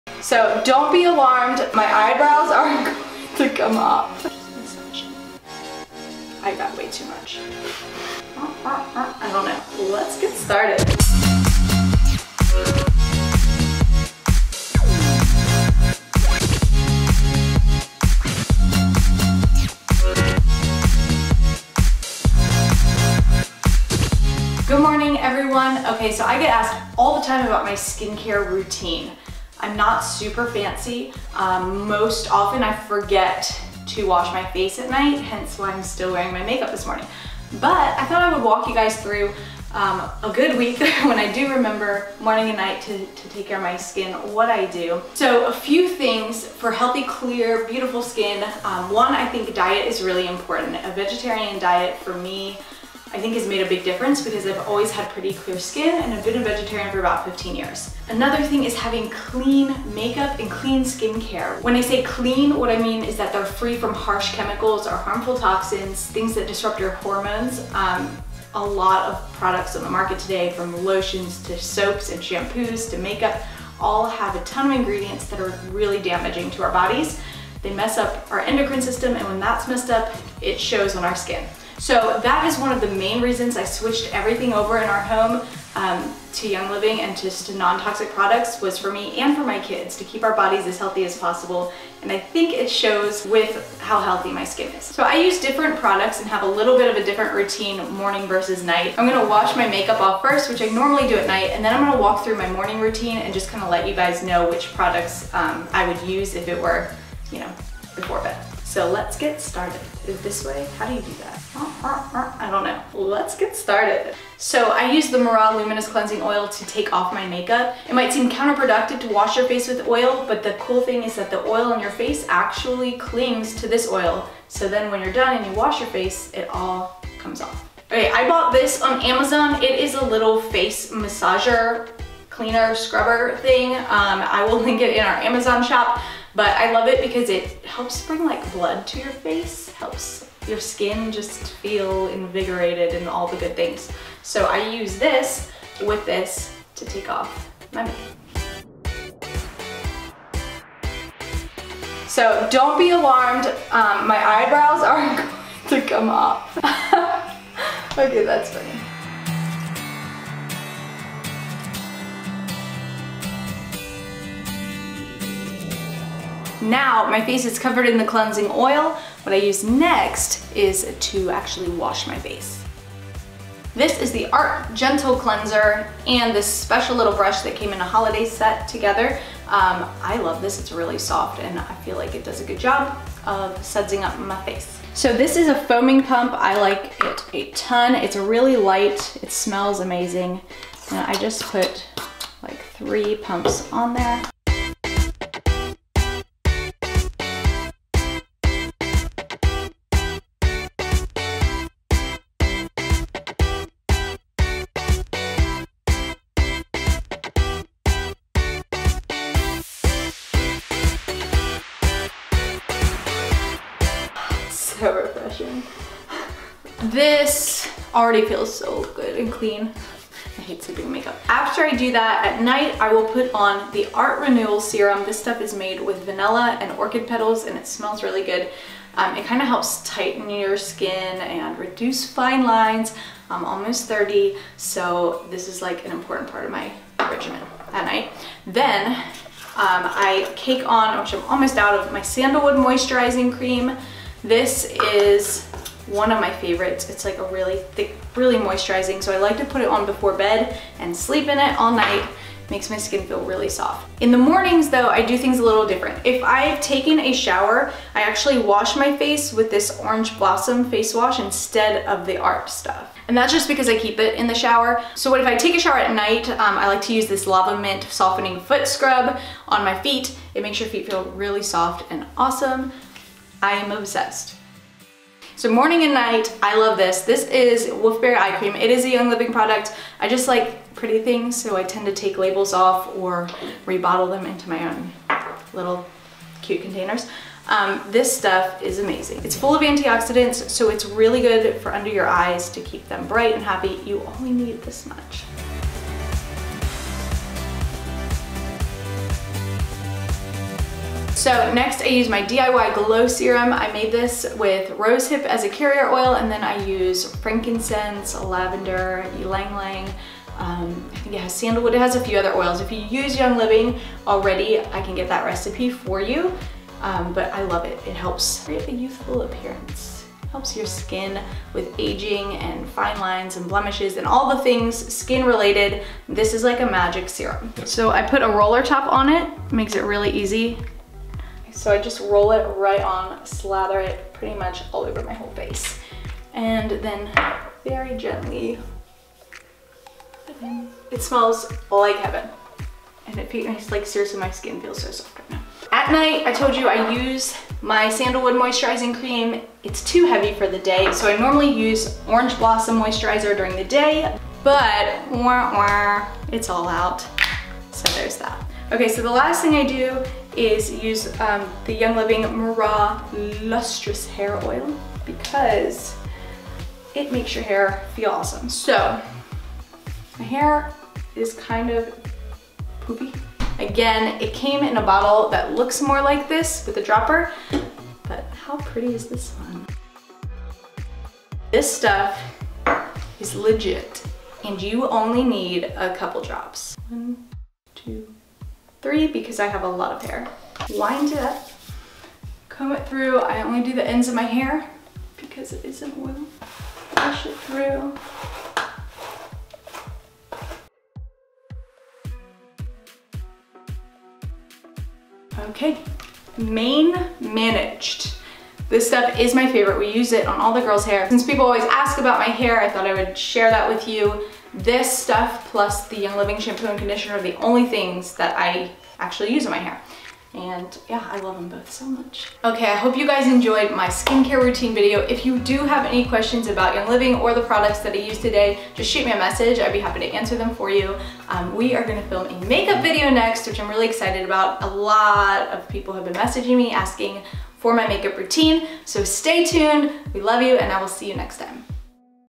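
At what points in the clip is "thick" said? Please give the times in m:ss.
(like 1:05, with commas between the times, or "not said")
4:07.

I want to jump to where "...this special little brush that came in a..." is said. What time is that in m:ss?
2:56.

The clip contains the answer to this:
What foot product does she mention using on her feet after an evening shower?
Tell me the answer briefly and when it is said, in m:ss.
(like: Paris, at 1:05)
Lava Mint Softening Foot Scrub, at 4:27.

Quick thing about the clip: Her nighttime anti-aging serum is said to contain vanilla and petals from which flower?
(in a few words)
Orchid.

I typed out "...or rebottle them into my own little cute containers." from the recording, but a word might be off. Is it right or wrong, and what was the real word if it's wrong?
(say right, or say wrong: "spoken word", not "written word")
right.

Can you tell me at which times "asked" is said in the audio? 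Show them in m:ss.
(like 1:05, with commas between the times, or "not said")
0:26.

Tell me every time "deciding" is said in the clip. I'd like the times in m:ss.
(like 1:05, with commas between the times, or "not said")
not said.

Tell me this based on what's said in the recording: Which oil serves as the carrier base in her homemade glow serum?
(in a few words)
Rosehip.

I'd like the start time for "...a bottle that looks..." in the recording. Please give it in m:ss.
6:14.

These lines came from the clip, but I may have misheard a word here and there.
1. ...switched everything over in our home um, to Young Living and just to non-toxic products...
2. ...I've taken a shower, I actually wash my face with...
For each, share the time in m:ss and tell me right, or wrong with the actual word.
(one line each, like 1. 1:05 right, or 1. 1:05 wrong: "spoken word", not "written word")
1. 1:23 right
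2. 4:16 right.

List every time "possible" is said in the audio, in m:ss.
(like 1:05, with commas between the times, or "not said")
1:31.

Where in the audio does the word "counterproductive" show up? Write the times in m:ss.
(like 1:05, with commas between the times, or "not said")
1:58.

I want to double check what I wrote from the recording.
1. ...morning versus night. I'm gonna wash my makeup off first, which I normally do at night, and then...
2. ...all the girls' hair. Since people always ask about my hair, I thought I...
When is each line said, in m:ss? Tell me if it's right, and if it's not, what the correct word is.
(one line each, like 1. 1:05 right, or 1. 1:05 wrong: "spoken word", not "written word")
1. 1:37 right
2. 6:50 right.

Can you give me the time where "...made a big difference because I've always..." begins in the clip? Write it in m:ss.
0:53.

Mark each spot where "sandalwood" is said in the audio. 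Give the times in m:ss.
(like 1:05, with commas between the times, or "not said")
4:02, 5:11, 5:47.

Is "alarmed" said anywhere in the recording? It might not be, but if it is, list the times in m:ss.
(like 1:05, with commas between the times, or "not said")
0:01, 2:32.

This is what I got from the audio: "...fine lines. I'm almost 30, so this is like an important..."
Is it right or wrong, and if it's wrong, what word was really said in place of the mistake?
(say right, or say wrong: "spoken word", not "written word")
right.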